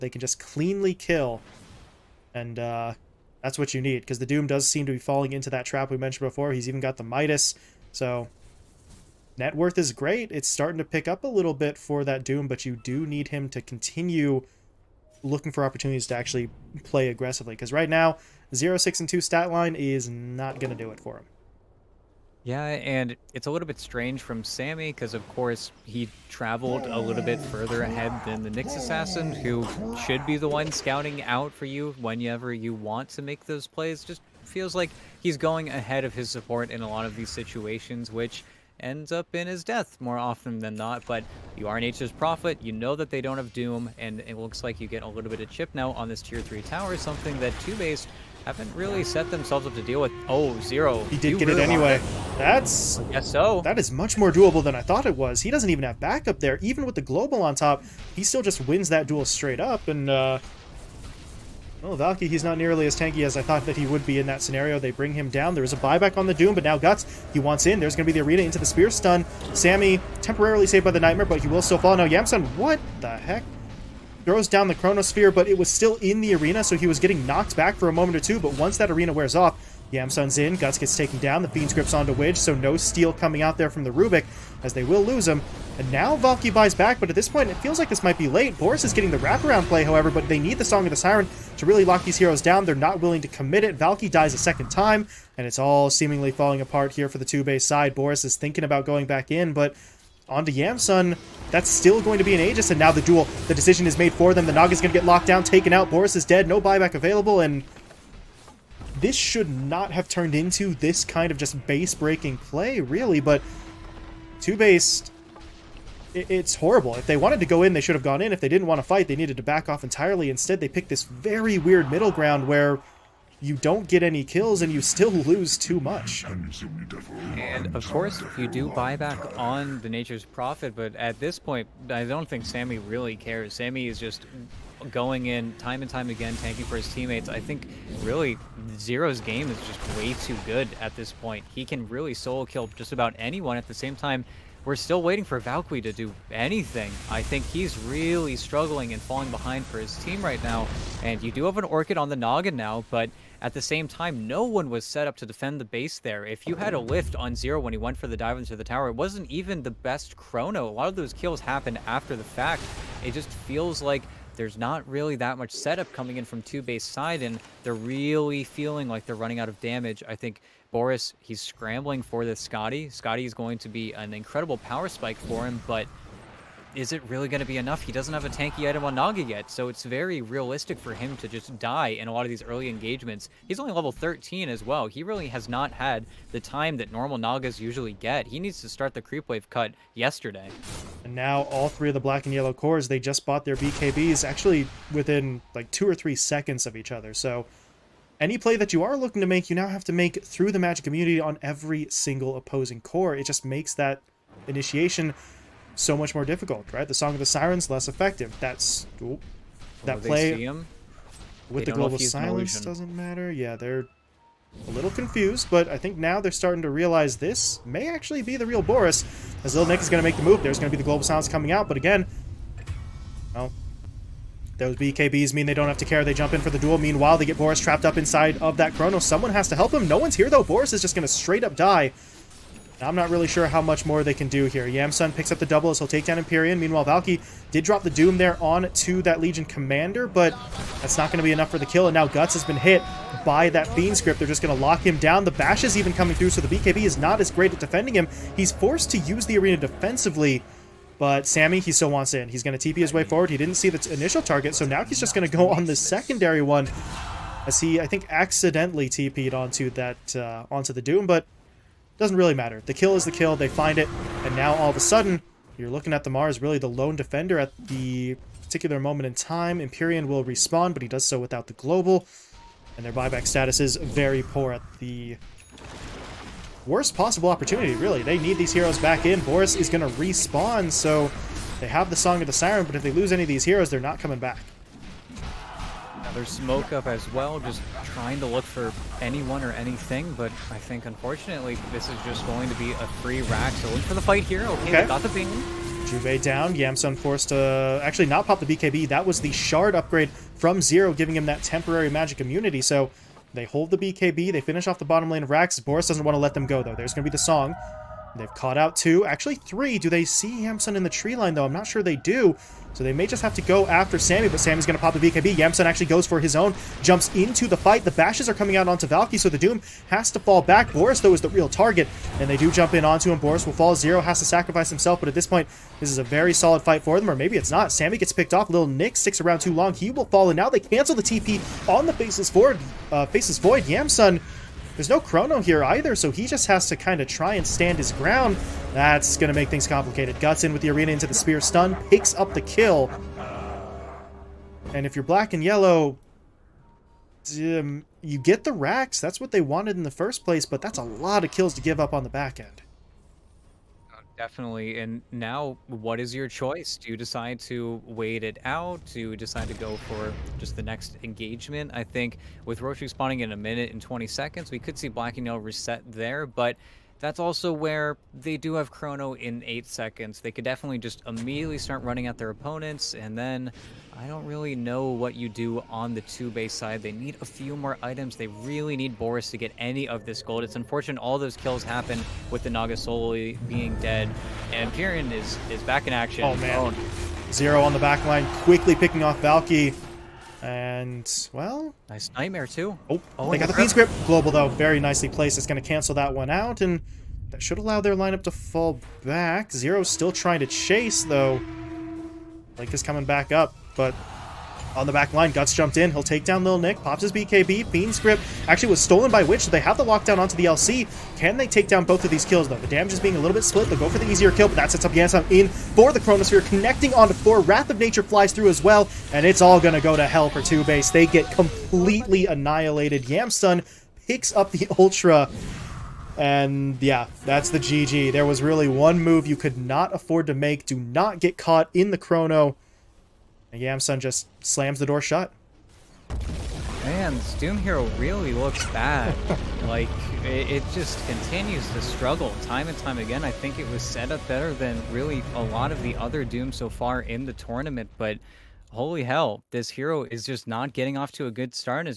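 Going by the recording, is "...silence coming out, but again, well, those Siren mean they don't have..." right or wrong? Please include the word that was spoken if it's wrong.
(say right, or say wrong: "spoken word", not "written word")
wrong: "BKBs", not "Siren".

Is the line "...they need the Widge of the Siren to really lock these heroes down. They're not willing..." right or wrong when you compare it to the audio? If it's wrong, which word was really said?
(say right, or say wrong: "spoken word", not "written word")
wrong: "Song", not "Widge".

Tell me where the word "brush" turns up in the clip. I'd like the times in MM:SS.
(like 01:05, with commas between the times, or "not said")
not said.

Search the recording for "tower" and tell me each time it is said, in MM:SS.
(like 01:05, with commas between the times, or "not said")
00:46, 02:38.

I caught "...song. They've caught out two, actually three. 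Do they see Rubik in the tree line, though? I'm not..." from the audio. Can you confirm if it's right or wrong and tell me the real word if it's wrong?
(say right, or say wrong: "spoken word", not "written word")
wrong: "Yamsun", not "Rubik".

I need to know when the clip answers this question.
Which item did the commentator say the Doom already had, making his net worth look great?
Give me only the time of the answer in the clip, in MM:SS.
00:07.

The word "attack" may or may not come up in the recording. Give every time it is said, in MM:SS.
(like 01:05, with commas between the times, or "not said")
not said.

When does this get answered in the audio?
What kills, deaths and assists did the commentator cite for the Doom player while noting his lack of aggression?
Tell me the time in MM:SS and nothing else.
00:18.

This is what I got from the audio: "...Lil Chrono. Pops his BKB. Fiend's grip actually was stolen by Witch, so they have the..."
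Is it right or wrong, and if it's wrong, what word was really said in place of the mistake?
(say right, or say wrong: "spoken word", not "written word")
wrong: "Nick", not "Chrono".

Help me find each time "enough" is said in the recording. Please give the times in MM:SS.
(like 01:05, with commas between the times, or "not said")
02:57, 04:01.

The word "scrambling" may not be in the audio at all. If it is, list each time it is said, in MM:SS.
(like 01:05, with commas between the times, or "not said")
02:51.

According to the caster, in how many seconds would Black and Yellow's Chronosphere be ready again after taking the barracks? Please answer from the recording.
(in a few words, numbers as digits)
8 seconds.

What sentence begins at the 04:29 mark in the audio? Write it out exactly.
Empyrean will respawn, but he does so without the global.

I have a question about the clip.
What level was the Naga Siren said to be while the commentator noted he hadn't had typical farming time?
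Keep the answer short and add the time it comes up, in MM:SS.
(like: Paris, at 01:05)
13, at 03:03.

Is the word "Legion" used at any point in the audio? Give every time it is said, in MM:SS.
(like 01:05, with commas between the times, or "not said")
03:59.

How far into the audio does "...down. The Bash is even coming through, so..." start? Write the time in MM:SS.
04:04.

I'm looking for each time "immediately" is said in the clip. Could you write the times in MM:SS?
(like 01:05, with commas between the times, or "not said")
06:11.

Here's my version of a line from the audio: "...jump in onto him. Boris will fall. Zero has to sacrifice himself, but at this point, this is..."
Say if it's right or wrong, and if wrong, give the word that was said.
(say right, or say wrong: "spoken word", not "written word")
right.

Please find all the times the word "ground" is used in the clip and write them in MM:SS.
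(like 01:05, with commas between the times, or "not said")
02:02, 05:37.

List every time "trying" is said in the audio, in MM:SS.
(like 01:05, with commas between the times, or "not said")
04:47, 06:40.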